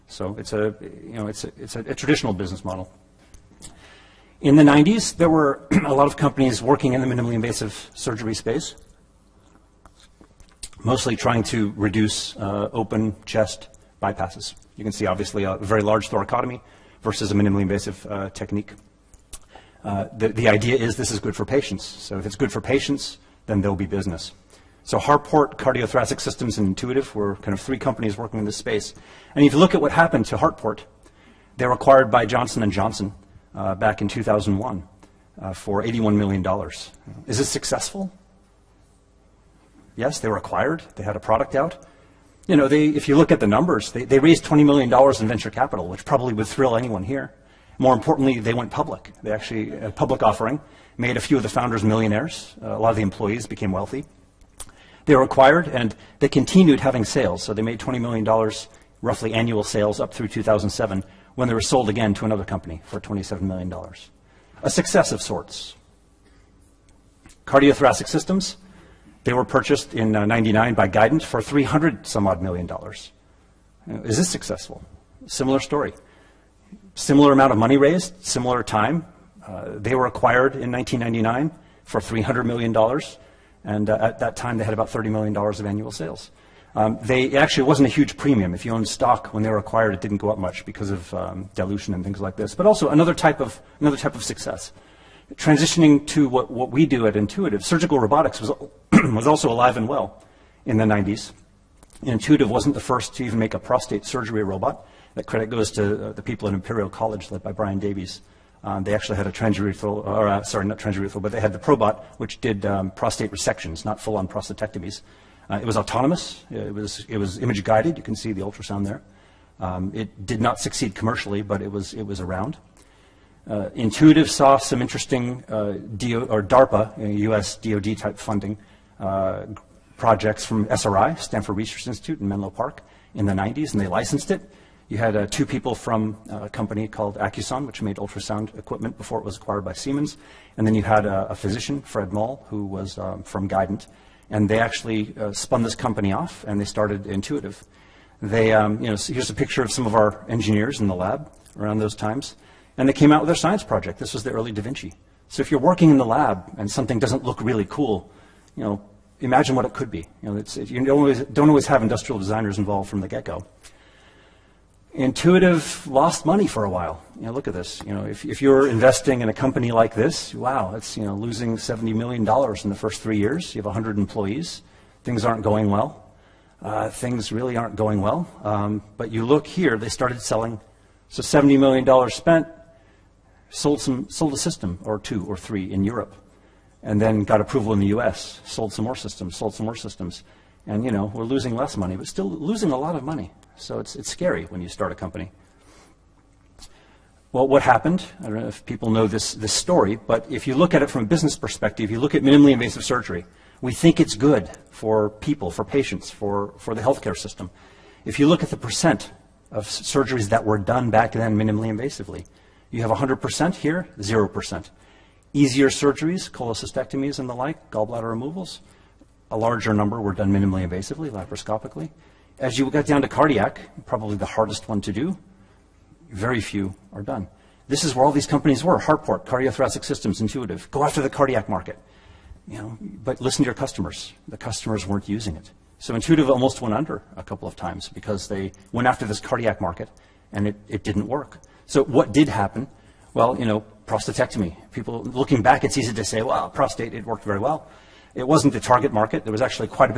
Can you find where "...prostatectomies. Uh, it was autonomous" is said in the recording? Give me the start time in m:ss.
1:54.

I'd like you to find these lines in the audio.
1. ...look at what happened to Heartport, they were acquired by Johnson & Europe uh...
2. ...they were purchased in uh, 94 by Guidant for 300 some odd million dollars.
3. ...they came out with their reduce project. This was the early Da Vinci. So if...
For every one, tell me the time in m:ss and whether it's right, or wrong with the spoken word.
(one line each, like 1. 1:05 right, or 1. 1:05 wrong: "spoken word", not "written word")
1. 0:29 wrong: "Johnson", not "Europe"
2. 1:09 wrong: "99", not "94"
3. 2:32 wrong: "science", not "reduce".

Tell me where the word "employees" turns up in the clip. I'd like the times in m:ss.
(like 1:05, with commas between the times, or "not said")
0:53, 2:53.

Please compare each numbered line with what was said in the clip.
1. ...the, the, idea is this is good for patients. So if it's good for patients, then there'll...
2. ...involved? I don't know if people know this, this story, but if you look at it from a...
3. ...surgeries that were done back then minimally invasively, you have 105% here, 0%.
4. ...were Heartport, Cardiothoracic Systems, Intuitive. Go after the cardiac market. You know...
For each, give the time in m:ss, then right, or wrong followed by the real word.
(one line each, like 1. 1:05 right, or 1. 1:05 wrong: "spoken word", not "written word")
1. 0:20 right
2. 3:17 wrong: "happened", not "involved"
3. 3:29 wrong: "100", not "105"
4. 3:48 right.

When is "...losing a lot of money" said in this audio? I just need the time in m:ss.
3:12.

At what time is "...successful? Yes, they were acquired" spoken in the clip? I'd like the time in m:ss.
0:37.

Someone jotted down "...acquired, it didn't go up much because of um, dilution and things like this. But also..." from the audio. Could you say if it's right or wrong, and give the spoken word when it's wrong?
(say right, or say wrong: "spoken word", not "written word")
right.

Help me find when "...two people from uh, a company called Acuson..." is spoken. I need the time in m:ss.
2:15.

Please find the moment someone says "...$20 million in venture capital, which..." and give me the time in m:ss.
0:44.